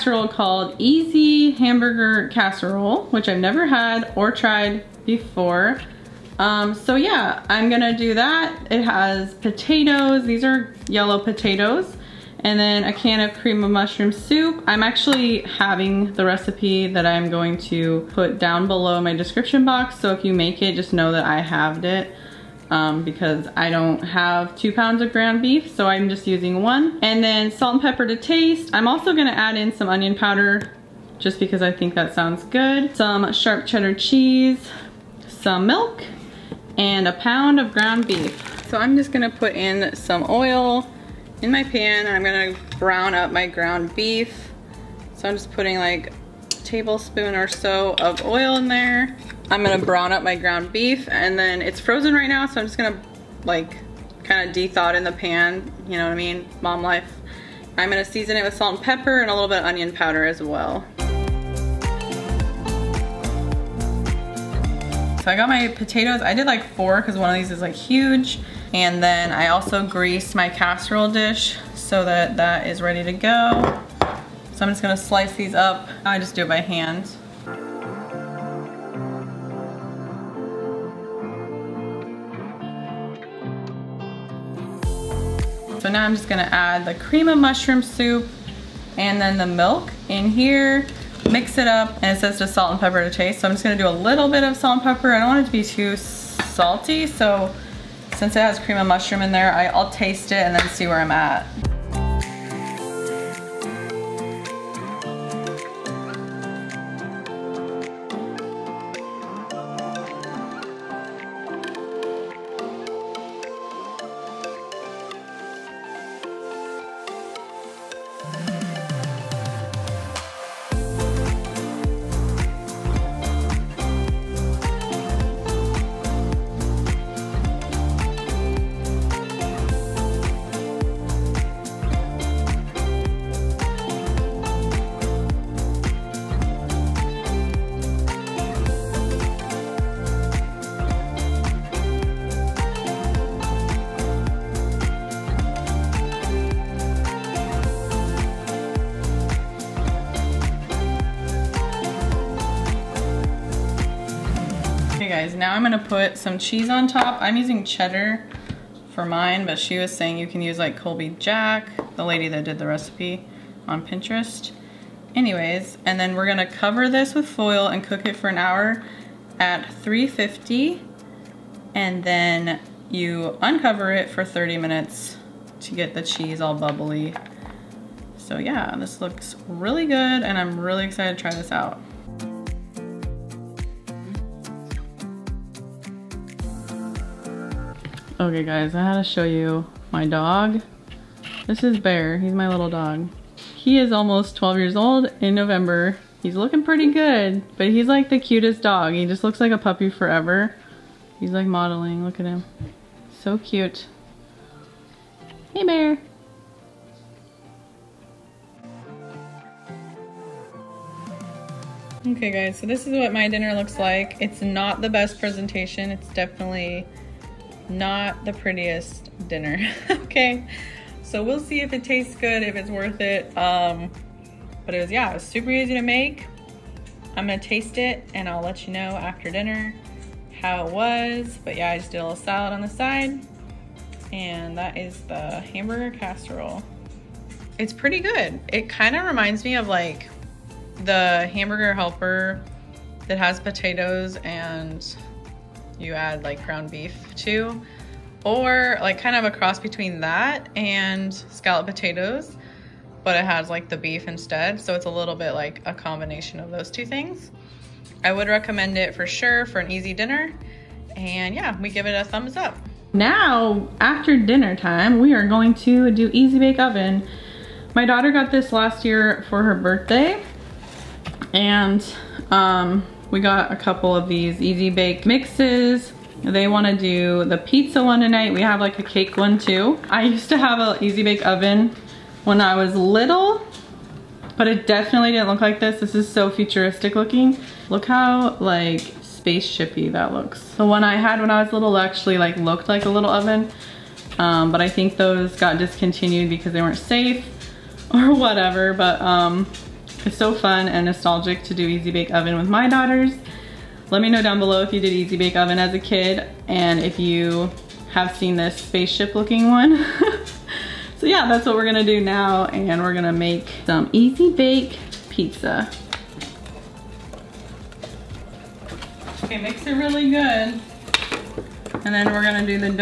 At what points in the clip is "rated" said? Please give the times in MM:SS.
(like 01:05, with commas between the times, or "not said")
not said.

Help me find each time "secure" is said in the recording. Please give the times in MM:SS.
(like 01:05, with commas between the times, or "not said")
not said.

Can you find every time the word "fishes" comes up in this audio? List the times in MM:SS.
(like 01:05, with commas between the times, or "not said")
not said.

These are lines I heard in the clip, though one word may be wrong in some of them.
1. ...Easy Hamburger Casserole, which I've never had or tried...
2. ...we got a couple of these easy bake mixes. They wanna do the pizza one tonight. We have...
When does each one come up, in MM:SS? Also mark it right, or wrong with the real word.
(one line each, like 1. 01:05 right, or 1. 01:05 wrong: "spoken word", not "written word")
1. 00:00 right
2. 04:33 right.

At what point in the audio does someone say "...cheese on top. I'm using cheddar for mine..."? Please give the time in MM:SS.
02:36.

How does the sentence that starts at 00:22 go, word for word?
Um, because I don't have two pounds of ground beef, so I'm just using one.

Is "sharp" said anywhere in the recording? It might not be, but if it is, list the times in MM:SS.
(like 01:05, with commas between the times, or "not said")
00:33.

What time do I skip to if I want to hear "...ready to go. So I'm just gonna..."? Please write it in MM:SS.
01:12.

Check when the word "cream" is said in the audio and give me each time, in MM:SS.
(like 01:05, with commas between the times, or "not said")
00:13, 01:26, 01:38.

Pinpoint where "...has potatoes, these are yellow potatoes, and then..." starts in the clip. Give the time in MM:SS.
00:08.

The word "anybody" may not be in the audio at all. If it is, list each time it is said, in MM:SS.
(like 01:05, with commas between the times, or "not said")
not said.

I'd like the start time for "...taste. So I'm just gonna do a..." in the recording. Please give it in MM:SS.
01:33.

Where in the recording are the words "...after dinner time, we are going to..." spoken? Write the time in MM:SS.
04:23.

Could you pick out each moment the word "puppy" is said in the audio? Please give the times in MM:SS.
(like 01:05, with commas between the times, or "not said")
03:19.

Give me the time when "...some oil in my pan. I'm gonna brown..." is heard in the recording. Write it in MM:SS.
00:39.